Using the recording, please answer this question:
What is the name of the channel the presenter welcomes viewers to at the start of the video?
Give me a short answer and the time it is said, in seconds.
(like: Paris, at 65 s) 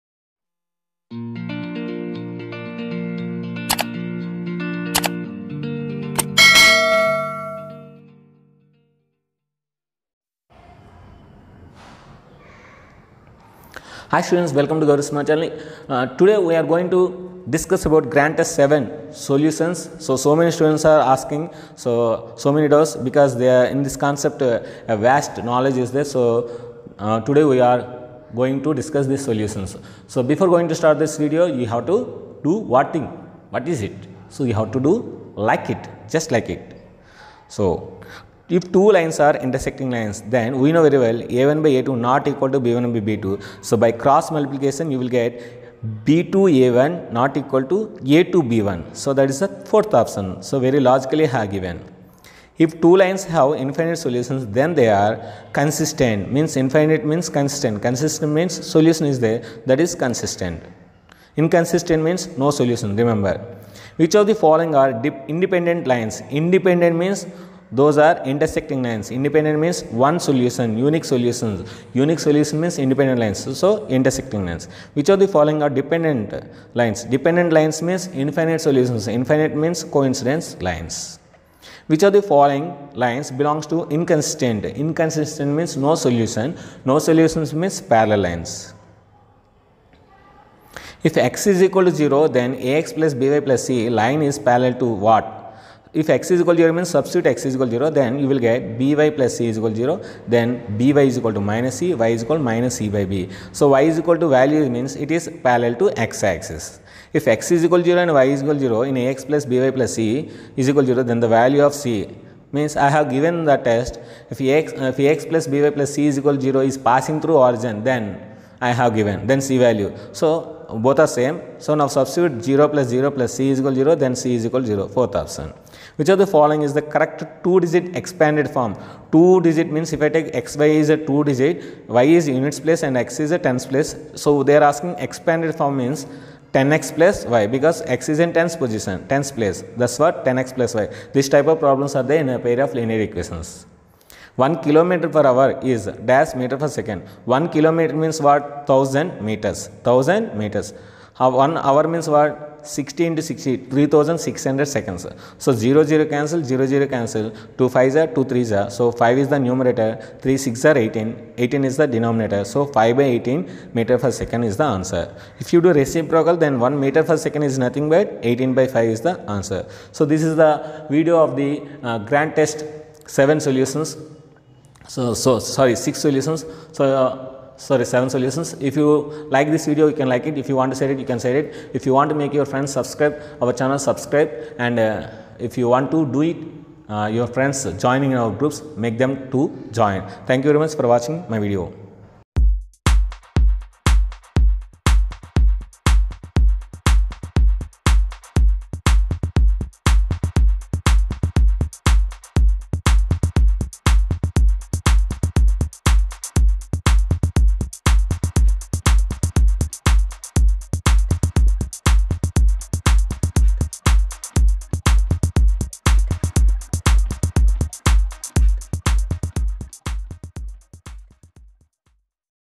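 Gowri Smart Channel, at 14 s.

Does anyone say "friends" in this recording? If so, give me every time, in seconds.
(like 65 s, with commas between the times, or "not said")
182 s, 187 s.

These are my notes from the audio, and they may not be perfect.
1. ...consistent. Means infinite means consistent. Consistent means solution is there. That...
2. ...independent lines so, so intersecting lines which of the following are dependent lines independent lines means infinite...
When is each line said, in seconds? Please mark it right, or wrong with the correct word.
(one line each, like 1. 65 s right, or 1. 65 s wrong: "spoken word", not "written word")
1. 55 s right
2. 72 s wrong: "dependent", not "independent".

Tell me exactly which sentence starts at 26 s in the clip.
So, uh, today we are going to discuss these solutions.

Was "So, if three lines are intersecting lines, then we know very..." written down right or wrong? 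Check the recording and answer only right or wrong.
wrong.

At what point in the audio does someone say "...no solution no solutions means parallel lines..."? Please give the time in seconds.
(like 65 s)
85 s.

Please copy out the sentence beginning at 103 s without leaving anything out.
So, y is equal to value means it is parallel to x axis.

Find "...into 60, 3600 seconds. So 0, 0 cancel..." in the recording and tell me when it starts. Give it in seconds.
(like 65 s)
153 s.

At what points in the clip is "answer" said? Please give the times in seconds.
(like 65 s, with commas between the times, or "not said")
164 s, 169 s.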